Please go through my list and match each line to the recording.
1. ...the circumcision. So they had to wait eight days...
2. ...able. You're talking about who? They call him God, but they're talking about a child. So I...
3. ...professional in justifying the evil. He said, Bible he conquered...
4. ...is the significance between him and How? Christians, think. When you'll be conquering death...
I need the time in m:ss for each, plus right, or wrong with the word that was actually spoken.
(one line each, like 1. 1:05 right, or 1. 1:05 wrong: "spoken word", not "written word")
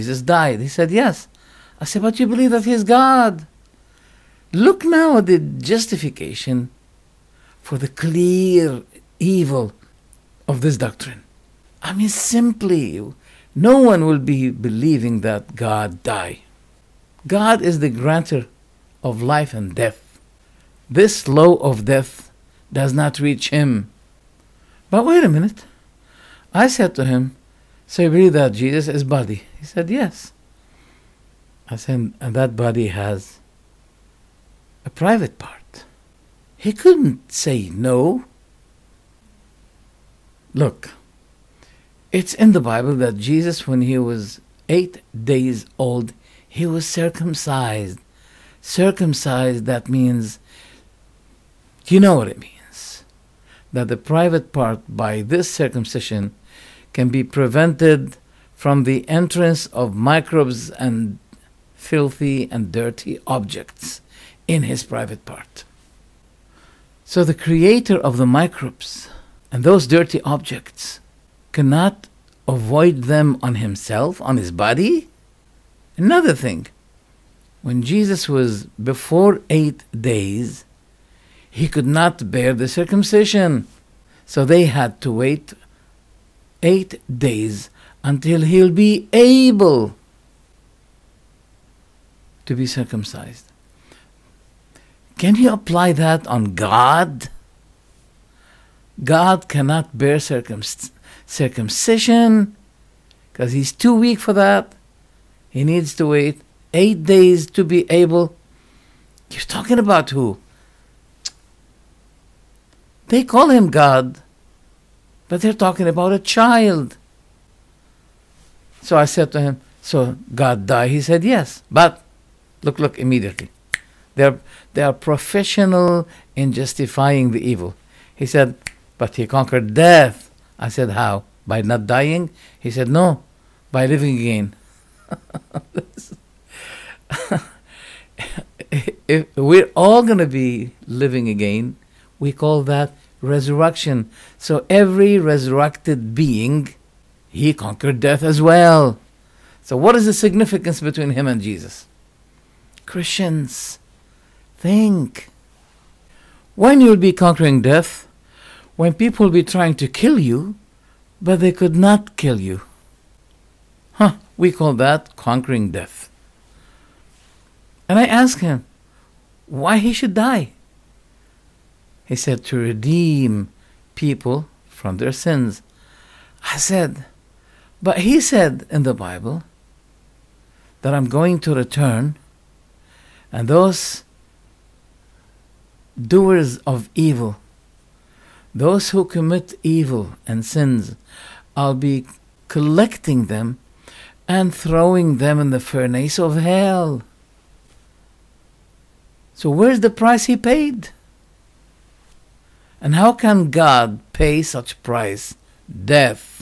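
1. 1:22 right
2. 1:47 right
3. 2:04 wrong: "But", not "Bible"
4. 2:29 wrong: "Jesus", not "How".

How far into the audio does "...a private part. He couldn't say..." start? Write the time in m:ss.
0:34.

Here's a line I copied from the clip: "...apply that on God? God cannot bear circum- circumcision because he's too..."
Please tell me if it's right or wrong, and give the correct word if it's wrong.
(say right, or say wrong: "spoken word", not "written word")
right.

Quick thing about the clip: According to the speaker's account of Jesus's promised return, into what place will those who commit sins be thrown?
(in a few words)
The furnace of hell.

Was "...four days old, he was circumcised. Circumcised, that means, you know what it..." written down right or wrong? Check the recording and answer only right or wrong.
wrong.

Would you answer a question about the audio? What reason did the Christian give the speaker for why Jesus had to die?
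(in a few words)
To redeem people.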